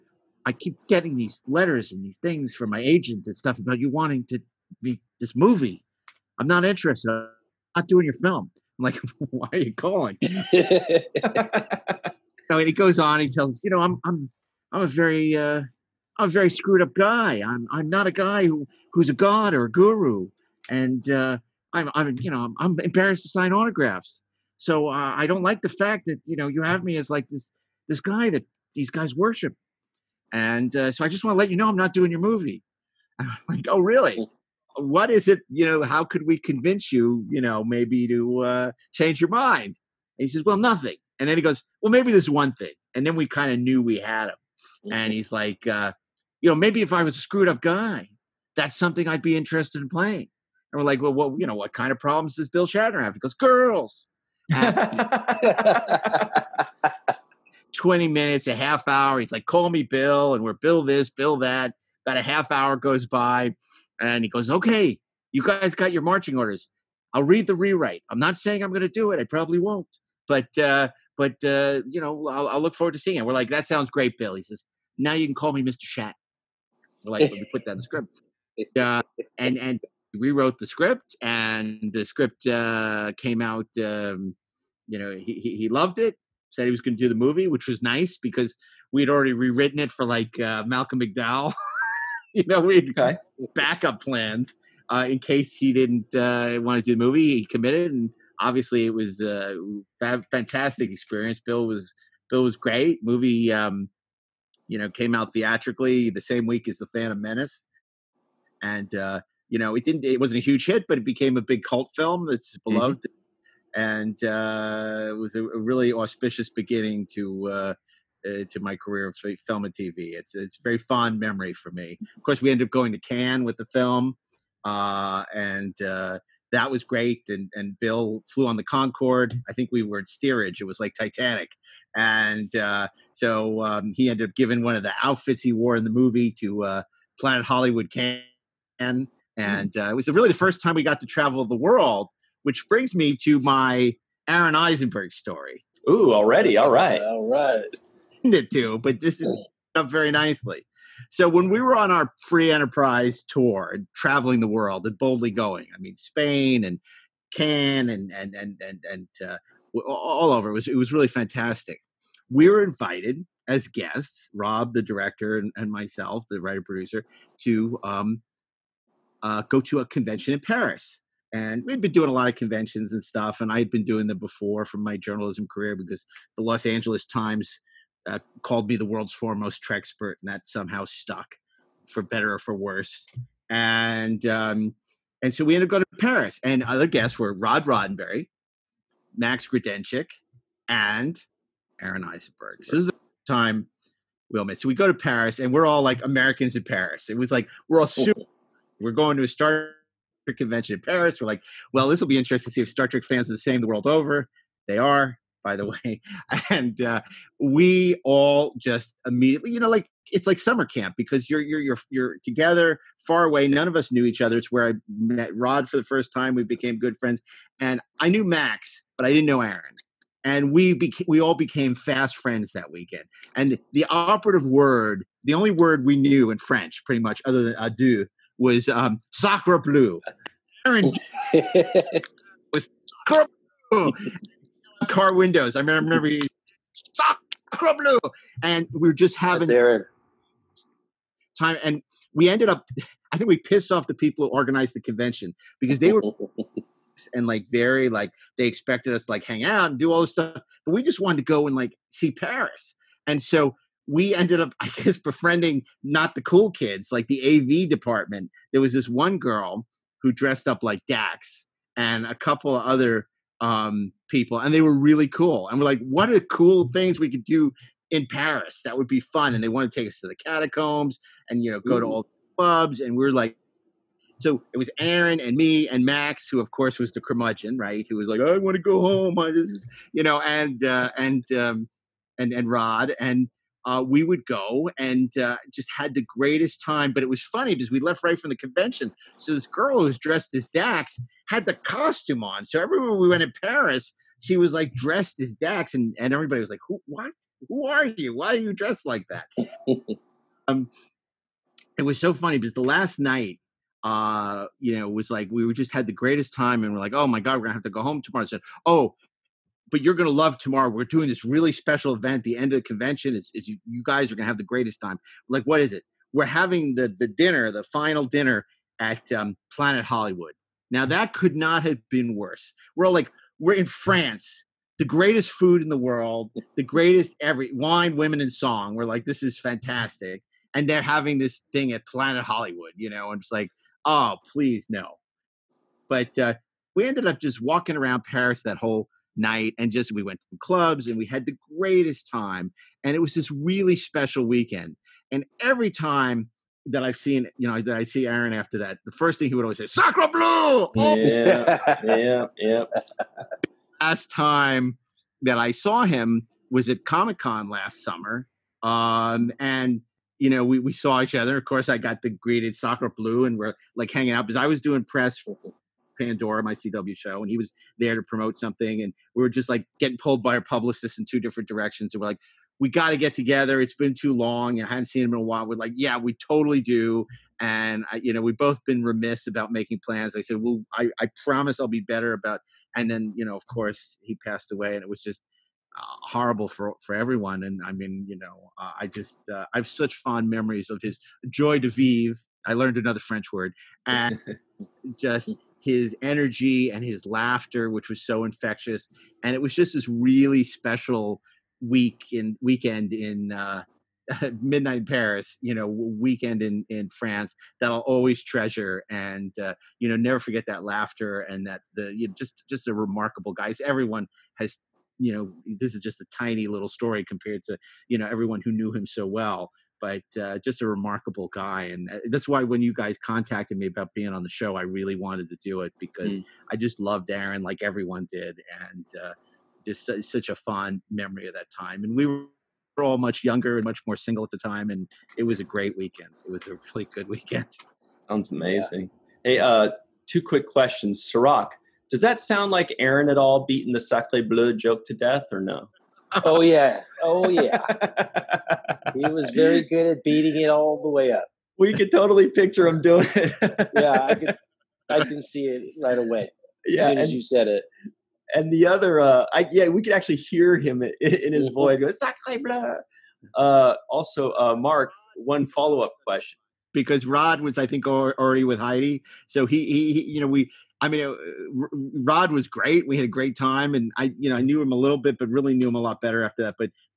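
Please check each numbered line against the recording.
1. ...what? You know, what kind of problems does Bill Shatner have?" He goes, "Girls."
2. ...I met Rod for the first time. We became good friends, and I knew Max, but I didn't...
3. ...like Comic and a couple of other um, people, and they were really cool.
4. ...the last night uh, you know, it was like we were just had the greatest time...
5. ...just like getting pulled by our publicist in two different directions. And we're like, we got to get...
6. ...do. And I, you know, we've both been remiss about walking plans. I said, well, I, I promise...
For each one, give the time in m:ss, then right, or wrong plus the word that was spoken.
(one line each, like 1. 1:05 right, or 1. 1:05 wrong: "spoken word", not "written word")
1. 0:51 right
2. 3:34 right
3. 4:20 wrong: "Dax", not "Comic"
4. 5:02 right
5. 6:09 right
6. 6:16 wrong: "making", not "walking".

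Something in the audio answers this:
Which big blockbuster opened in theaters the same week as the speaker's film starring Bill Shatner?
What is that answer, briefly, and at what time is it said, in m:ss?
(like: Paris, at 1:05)
The Phantom Menace, at 1:46.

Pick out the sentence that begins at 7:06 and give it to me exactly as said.
I just loved Aron like everyone did.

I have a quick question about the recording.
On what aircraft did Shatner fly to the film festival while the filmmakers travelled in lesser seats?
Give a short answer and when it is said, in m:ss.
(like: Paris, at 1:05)
The Concorde, at 2:08.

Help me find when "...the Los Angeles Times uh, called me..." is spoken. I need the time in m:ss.
2:56.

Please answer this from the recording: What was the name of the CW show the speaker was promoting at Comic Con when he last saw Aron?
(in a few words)
Pandora.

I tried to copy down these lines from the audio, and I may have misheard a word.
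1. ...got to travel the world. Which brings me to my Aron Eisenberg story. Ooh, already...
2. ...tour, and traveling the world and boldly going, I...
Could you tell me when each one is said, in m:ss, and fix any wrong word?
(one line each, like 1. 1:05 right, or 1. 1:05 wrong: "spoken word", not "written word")
1. 2:20 right
2. 2:33 right.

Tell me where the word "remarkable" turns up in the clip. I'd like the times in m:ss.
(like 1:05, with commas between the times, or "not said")
6:52, 7:00.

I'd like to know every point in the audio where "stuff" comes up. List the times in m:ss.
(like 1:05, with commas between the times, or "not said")
0:03, 2:53, 4:10.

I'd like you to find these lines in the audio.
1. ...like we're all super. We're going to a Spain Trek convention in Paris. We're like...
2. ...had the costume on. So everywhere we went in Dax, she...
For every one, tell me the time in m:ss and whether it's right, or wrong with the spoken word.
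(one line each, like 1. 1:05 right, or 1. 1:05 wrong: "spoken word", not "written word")
1. 3:17 wrong: "Star", not "Spain"
2. 4:51 wrong: "Paris", not "Dax".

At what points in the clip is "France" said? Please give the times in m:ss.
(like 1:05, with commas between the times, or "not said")
5:23, 6:46.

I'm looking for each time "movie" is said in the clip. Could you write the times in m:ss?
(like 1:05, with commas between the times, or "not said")
0:05, 0:32, 1:27, 1:37, 1:43, 2:15.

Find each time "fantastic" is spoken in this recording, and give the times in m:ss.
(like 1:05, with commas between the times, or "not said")
1:40, 2:41, 5:29.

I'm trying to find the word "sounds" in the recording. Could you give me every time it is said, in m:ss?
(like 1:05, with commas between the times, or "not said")
1:13, 7:18, 7:22.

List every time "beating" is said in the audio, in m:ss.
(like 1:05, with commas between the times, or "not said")
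7:23, 7:30.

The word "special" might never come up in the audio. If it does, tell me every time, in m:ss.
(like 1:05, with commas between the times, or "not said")
5:11, 5:43, 6:40.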